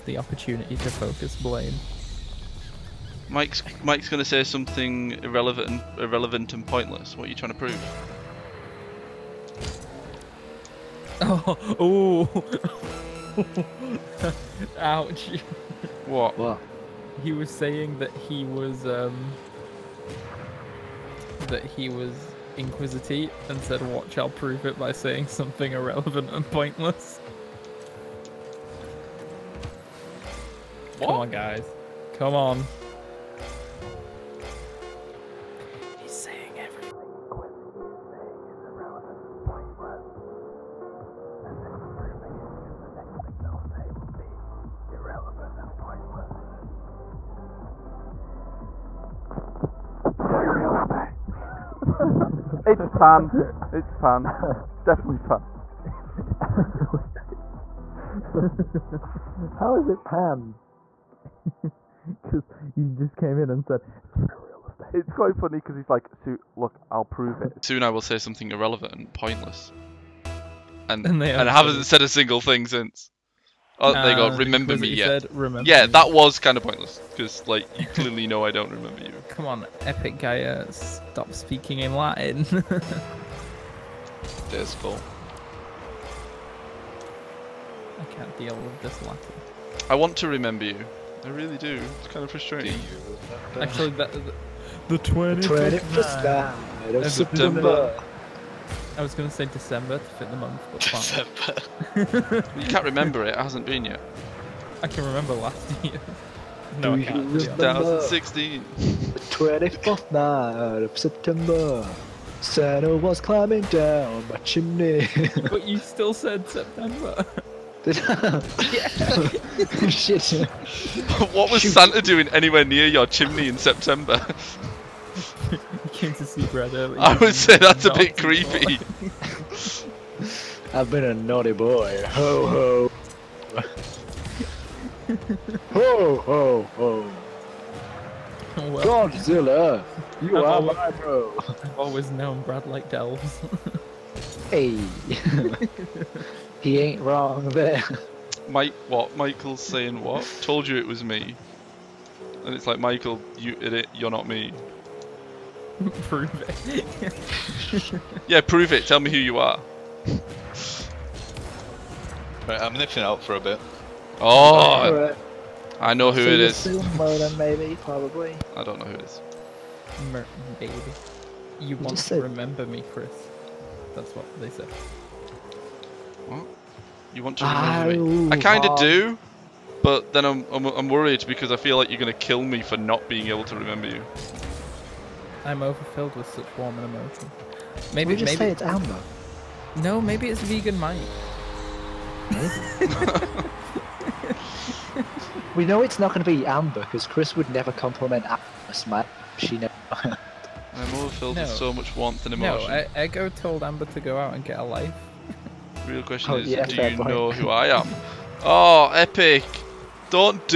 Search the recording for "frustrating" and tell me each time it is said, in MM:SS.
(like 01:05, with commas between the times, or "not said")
01:32.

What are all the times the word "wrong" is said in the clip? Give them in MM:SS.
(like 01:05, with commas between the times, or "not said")
02:27.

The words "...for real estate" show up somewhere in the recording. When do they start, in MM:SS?
01:04.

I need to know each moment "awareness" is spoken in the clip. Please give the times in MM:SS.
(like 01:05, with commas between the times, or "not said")
not said.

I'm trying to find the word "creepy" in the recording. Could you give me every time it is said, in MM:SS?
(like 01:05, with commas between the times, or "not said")
02:08.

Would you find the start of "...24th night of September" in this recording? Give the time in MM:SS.
01:49.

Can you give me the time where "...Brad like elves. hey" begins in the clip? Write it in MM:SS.
02:22.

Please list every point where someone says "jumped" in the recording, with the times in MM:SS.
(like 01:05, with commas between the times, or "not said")
not said.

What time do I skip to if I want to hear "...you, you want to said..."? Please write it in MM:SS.
02:51.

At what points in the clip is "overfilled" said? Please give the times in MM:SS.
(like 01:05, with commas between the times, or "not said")
03:05, 03:20.